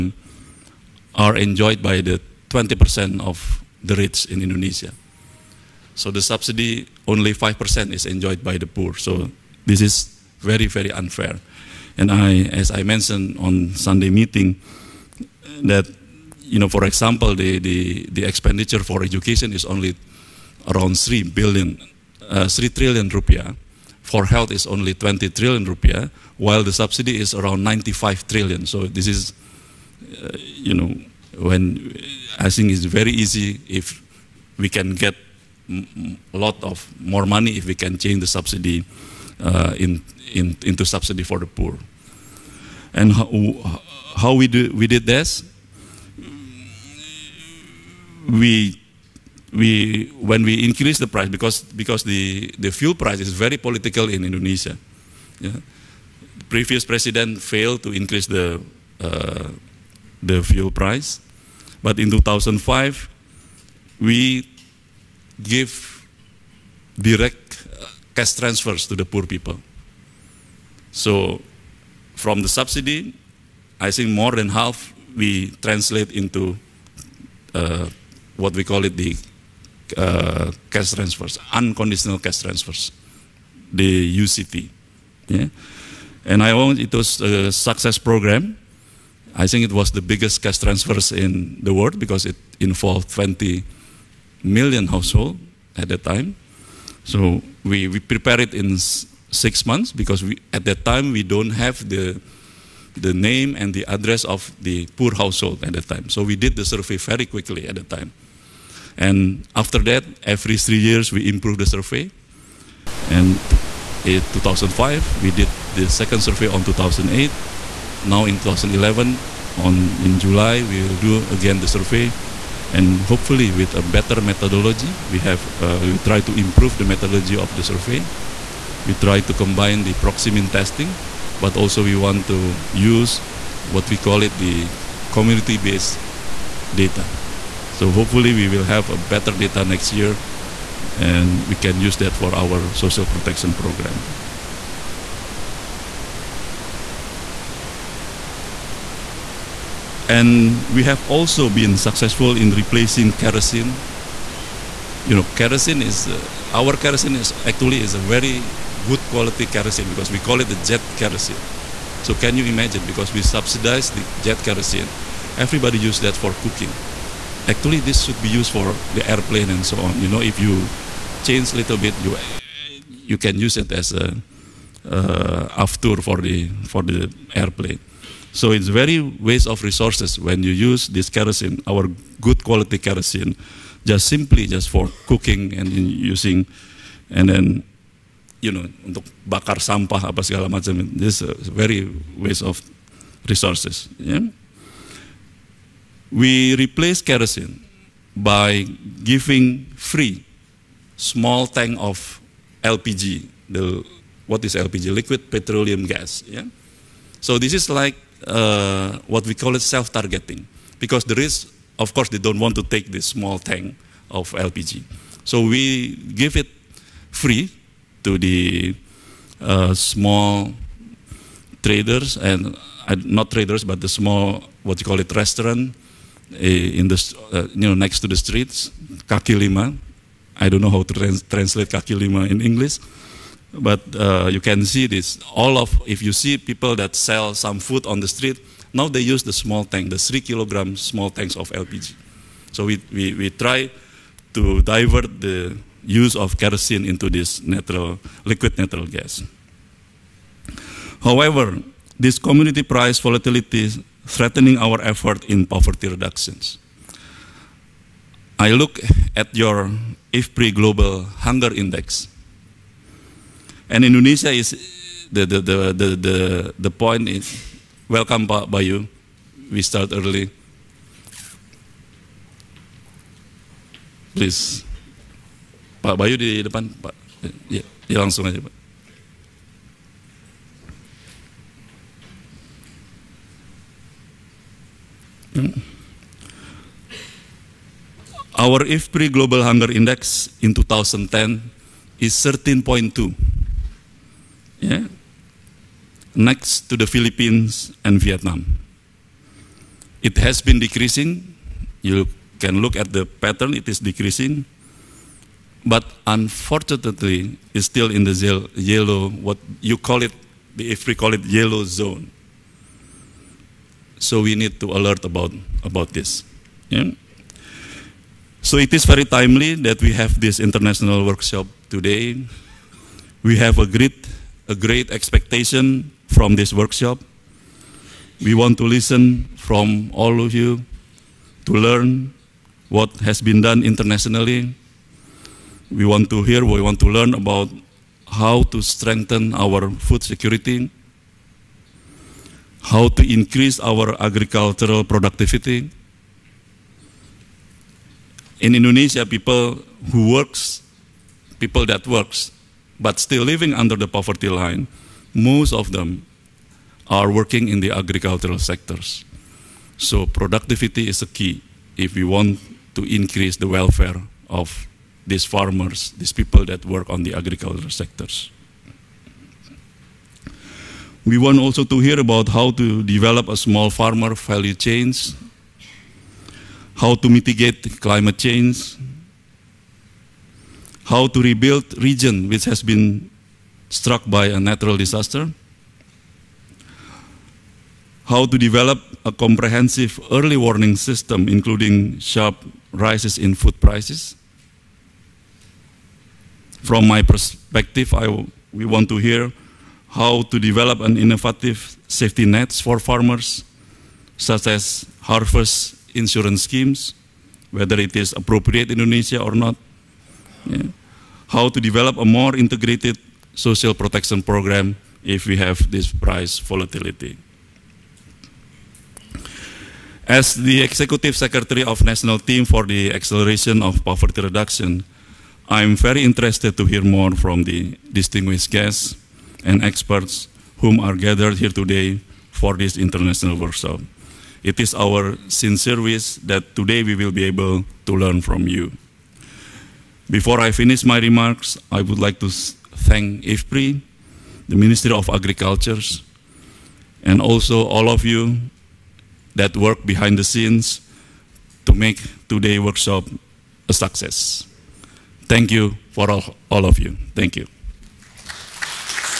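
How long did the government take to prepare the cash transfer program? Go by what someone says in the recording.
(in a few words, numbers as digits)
6 months.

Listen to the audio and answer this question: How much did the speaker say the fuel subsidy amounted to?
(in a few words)
95 trillion.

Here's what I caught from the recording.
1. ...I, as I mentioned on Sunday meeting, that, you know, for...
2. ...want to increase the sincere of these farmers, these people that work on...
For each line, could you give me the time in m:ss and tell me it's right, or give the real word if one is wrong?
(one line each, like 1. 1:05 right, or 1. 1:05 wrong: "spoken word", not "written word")
1. 0:12 right
2. 6:02 wrong: "welfare", not "sincere".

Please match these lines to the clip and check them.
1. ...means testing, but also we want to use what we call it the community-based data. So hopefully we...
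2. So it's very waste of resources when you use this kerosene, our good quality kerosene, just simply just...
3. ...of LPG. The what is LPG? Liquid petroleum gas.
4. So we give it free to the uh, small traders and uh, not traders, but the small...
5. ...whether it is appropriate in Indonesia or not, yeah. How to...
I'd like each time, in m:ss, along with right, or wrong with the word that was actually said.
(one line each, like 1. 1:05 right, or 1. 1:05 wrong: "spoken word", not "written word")
1. 2:10 right
2. 2:58 right
3. 3:21 right
4. 3:35 right
5. 6:47 right.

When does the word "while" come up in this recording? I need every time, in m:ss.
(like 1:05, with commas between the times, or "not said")
0:26.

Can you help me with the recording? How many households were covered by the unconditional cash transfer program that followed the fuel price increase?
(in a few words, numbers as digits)
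20 million.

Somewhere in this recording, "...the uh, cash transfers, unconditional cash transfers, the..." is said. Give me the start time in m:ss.
1:18.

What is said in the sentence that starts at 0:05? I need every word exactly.
So the subsidy only 5% is enjoyed by the poor.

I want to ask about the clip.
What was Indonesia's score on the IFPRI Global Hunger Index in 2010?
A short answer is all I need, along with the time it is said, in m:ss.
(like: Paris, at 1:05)
13.2, at 4:52.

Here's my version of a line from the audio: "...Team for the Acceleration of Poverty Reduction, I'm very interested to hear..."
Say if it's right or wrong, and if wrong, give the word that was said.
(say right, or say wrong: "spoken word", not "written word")
right.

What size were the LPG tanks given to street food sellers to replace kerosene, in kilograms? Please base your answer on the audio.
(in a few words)
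3 kilograms.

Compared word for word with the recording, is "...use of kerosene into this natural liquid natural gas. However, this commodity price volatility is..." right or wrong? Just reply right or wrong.
right.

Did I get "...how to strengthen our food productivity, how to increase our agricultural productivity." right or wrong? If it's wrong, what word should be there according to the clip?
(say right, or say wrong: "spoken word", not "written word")
wrong: "security", not "productivity".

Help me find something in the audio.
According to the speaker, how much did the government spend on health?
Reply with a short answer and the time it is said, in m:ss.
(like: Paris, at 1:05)
20 trillion rupiah, at 0:24.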